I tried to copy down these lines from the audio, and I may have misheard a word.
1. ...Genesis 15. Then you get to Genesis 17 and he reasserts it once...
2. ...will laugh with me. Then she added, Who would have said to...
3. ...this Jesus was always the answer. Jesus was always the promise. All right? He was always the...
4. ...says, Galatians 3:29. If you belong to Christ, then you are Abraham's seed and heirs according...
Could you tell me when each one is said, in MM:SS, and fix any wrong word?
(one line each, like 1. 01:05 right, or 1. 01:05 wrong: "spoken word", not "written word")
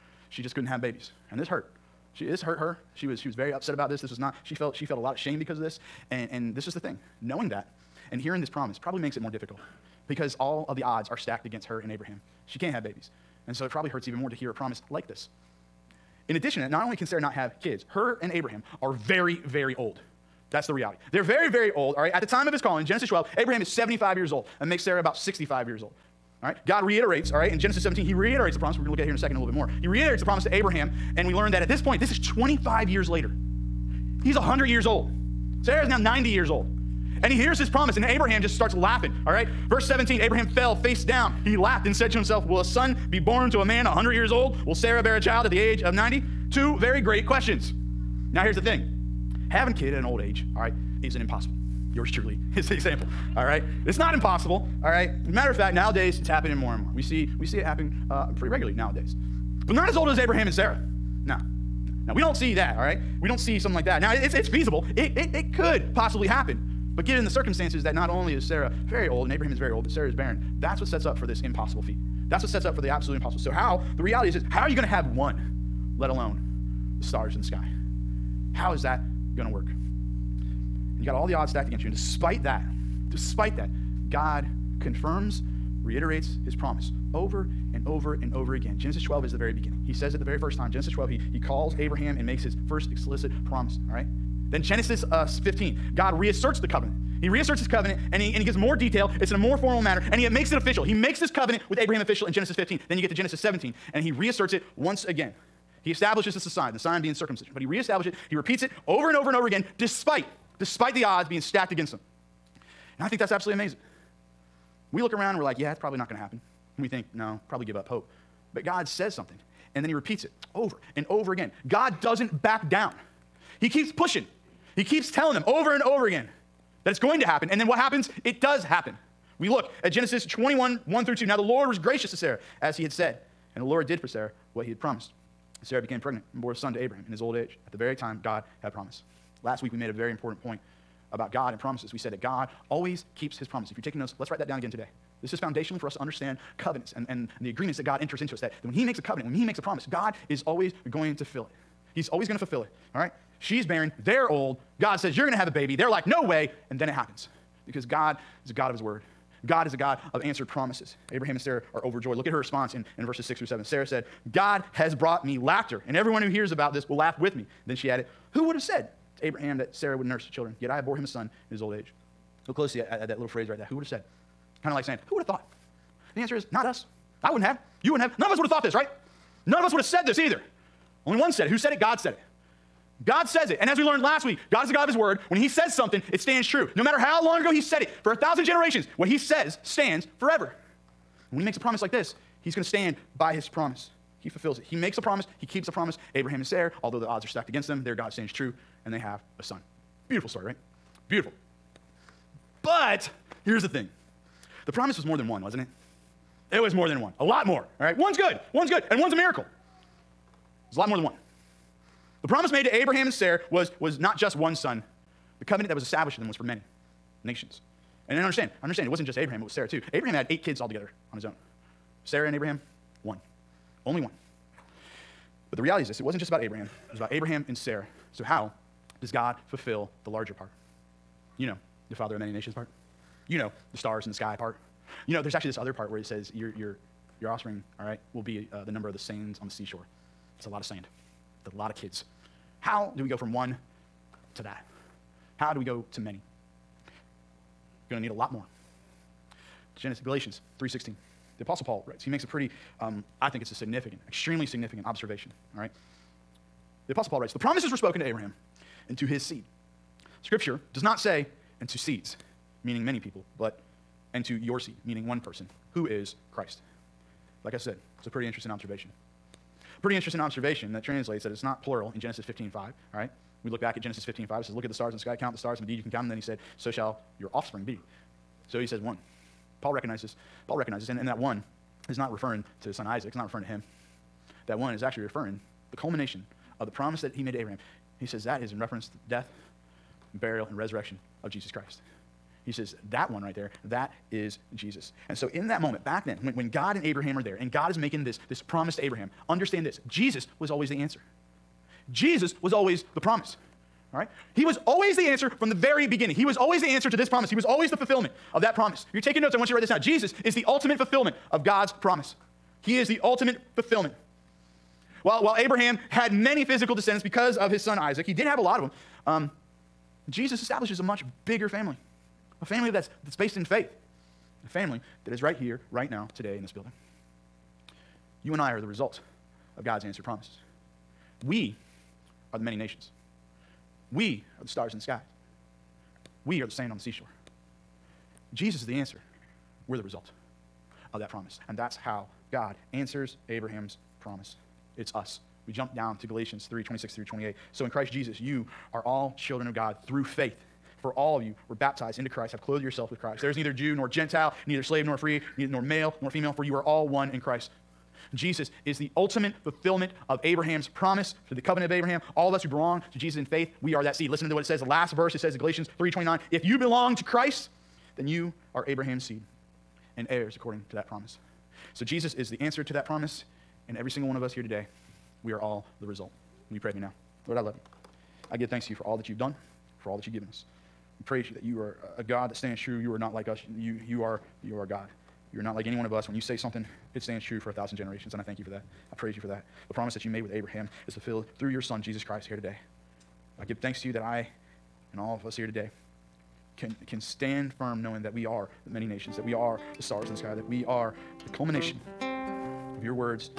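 1. 01:42 right
2. 02:46 right
3. 04:59 right
4. 06:05 right.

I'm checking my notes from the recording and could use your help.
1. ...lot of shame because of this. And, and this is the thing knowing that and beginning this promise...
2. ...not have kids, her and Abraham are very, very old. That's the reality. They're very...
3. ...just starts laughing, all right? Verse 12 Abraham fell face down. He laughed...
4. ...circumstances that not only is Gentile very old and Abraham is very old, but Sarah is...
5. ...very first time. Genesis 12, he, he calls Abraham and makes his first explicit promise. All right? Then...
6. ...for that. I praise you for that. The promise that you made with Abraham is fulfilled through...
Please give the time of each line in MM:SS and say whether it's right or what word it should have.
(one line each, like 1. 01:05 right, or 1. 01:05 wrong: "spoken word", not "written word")
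1. 00:04 wrong: "hearing", not "beginning"
2. 00:17 right
3. 00:38 wrong: "17", not "12"
4. 01:07 wrong: "Sarah", not "Gentile"
5. 01:30 right
6. 06:28 right.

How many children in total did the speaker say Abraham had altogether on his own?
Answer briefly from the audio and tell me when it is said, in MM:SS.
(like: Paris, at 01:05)
8, at 03:40.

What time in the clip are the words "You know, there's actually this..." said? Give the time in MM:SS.
03:55.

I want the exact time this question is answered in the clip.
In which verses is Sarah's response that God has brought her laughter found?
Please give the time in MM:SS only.
02:43.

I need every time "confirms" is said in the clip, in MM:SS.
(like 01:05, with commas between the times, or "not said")
01:24.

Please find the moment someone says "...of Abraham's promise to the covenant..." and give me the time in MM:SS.
06:00.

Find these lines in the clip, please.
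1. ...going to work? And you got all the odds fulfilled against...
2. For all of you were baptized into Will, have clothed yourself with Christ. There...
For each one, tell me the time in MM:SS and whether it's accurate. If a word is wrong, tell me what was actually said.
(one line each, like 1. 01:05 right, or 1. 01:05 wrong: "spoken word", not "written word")
1. 01:19 wrong: "stacked", not "fulfilled"
2. 05:50 wrong: "Christ", not "Will".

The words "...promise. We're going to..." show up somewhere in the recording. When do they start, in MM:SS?
00:28.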